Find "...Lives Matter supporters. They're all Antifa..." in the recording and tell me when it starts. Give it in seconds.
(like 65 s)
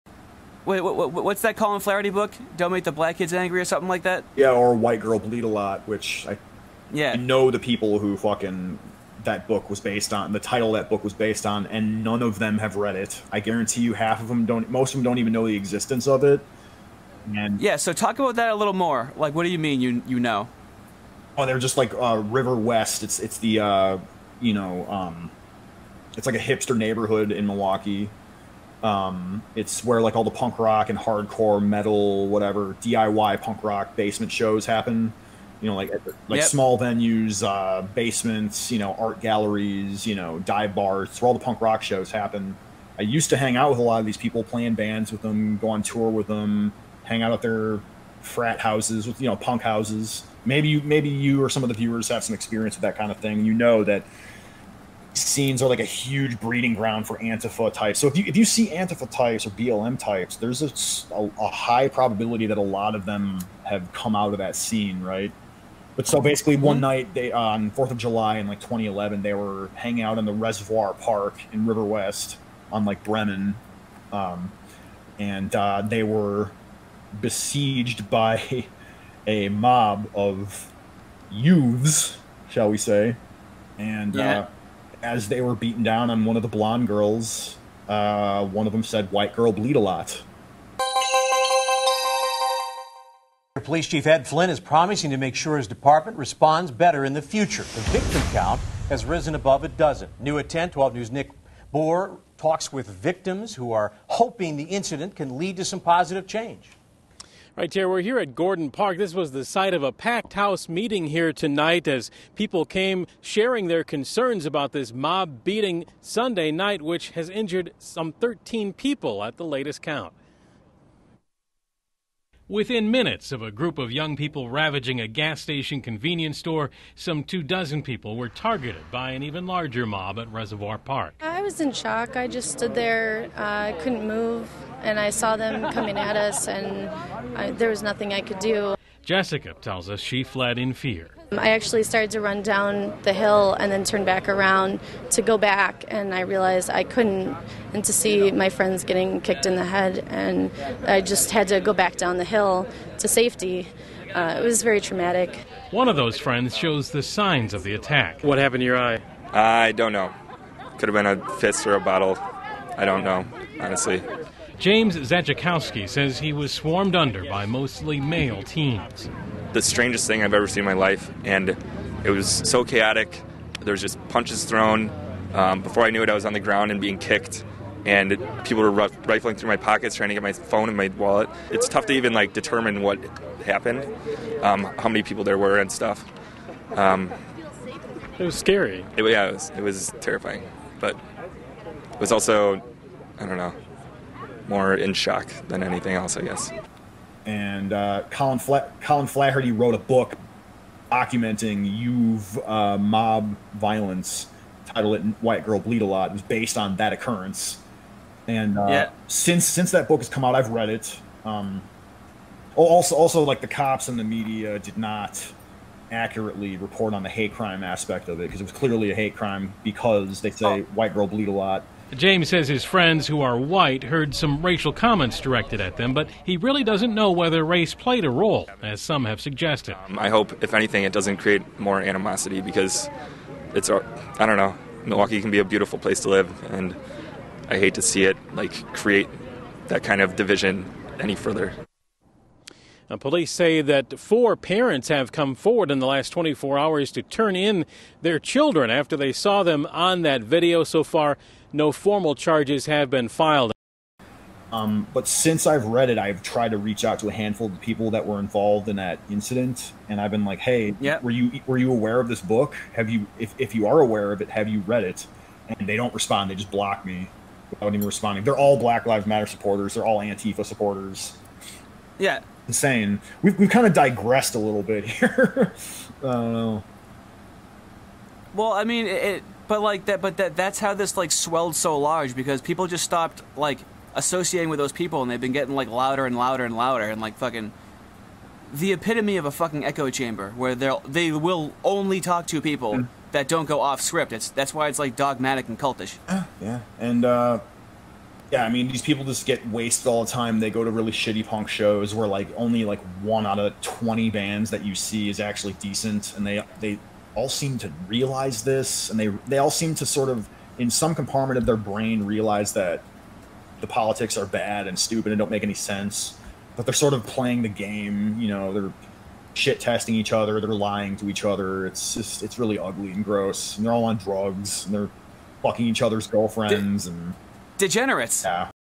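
268 s.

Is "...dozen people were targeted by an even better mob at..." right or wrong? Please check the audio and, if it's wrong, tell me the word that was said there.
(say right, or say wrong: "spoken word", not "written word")
wrong: "larger", not "better".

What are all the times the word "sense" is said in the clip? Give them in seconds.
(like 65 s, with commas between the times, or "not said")
315 s.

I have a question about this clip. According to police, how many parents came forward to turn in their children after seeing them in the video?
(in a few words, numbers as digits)
4.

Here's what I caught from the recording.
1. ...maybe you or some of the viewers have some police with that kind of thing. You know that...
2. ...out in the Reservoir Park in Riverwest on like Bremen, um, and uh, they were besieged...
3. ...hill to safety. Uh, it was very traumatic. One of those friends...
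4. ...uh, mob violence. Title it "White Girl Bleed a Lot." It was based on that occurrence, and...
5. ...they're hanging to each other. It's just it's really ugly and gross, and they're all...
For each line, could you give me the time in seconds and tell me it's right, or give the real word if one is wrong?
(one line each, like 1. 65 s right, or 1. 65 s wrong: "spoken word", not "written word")
1. 50 s wrong: "experience", not "police"
2. 70 s right
3. 152 s right
4. 202 s right
5. 320 s wrong: "lying", not "hanging".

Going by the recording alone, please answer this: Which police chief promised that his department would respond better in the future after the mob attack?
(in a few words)
Ed Flynn.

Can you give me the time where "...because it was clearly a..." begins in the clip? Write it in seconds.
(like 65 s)
218 s.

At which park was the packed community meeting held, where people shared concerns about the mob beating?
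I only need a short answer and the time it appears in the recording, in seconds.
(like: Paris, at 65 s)
Gordon Park, at 108 s.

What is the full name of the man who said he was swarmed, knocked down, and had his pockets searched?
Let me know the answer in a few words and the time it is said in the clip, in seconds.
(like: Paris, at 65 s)
James Zajakowski, at 164 s.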